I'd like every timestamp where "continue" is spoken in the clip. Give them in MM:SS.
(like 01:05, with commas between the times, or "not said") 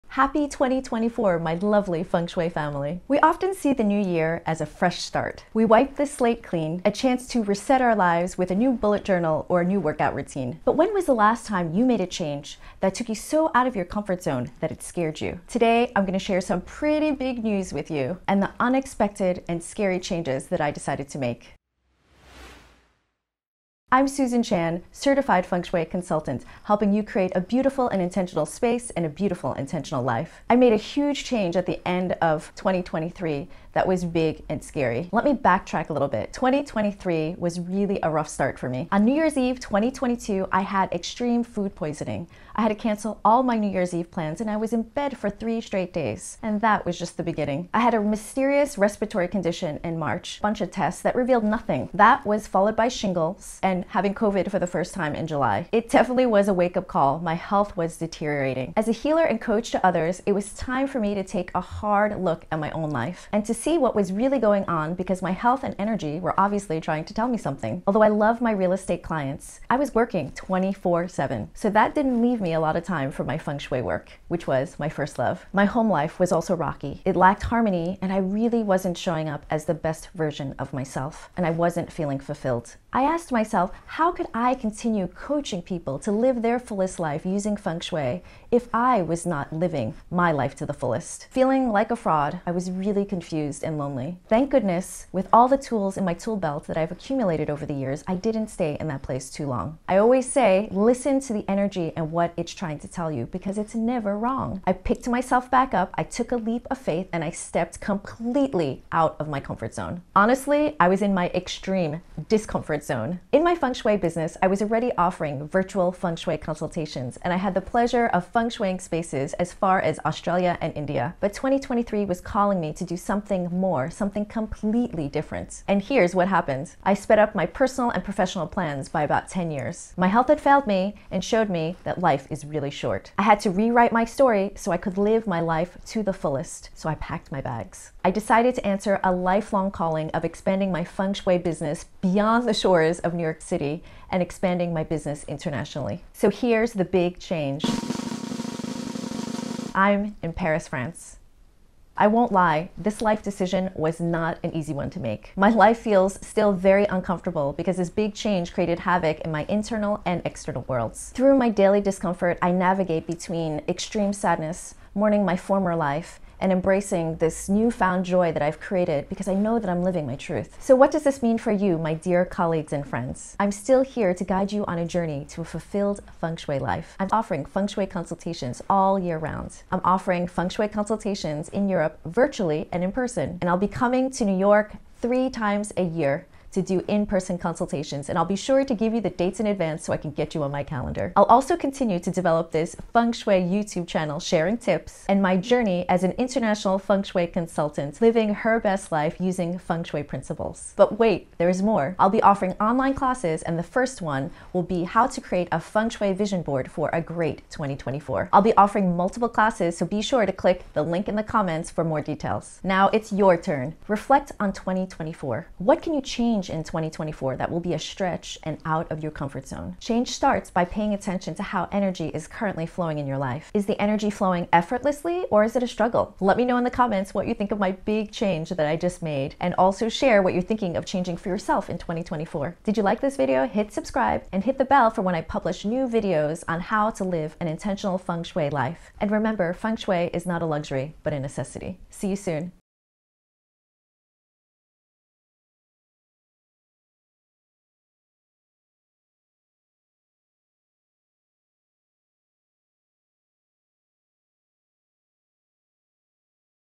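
01:24, 03:11.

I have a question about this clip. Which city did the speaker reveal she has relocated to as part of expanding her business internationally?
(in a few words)
Paris.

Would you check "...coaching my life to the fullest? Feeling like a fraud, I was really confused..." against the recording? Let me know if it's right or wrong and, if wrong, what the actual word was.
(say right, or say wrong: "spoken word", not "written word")
wrong: "living", not "coaching".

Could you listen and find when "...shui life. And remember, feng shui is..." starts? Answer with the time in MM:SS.
03:58.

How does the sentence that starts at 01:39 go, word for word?
I always say, listen to the energy and what it's trying to tell you because it's never wrong.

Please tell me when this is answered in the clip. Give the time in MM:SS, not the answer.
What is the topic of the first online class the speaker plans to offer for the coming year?
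03:25.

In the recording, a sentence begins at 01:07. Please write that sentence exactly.
Although I love my real estate clients, I was working 24 7.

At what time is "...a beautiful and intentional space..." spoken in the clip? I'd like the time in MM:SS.
00:27.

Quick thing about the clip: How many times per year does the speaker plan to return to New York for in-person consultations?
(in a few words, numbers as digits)
3.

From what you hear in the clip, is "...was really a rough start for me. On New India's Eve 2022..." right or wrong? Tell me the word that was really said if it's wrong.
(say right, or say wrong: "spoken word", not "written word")
wrong: "Year", not "India".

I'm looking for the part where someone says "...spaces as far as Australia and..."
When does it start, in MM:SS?
01:58.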